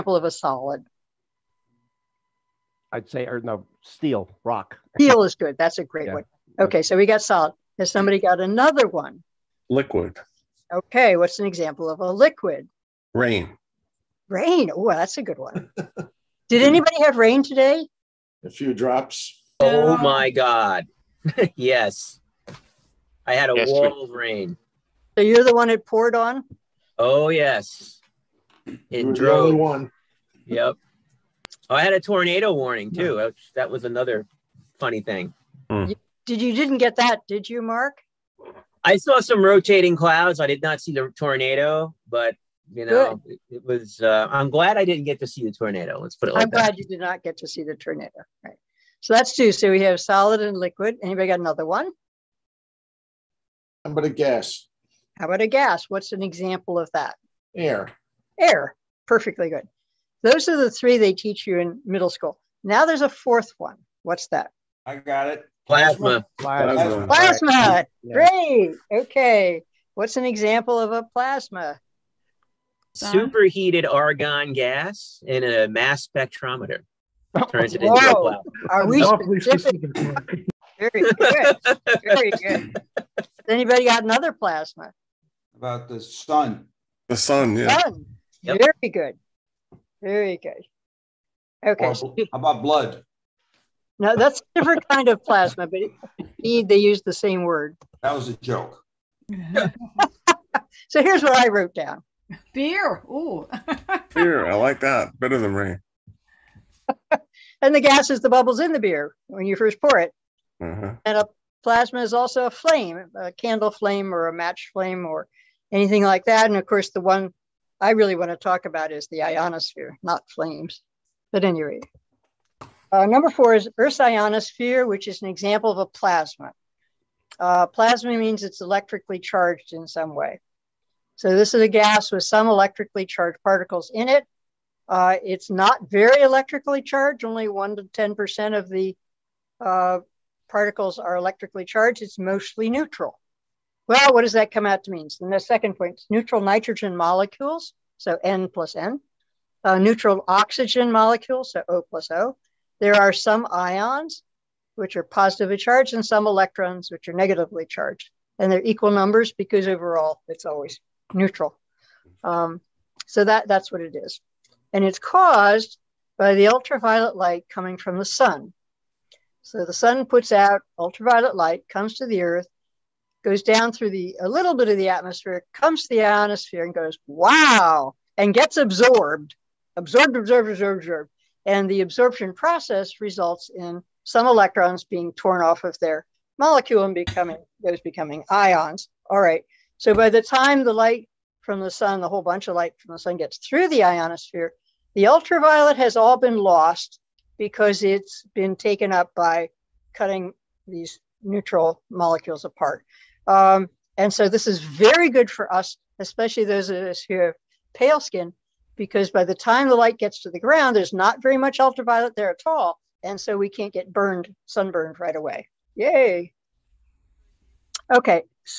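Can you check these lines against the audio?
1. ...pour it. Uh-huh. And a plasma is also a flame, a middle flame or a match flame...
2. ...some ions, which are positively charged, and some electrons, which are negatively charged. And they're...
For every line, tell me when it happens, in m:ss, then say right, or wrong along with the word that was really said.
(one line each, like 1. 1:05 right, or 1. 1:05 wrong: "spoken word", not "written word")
1. 1:49 wrong: "candle", not "middle"
2. 2:33 right.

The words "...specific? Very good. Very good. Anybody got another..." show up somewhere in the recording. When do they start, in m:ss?
1:19.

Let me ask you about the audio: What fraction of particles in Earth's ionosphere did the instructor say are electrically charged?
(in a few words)
1 to 10%.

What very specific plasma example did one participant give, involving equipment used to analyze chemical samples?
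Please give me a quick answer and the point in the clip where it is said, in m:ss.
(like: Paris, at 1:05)
Superheated argon gas, at 1:13.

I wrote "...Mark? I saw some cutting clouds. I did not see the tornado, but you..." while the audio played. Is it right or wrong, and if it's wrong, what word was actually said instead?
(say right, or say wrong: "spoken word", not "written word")
wrong: "rotating", not "cutting".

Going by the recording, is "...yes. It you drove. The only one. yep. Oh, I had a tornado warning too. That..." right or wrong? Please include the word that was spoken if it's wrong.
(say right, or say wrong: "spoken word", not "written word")
right.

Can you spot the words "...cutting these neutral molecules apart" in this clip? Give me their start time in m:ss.
3:19.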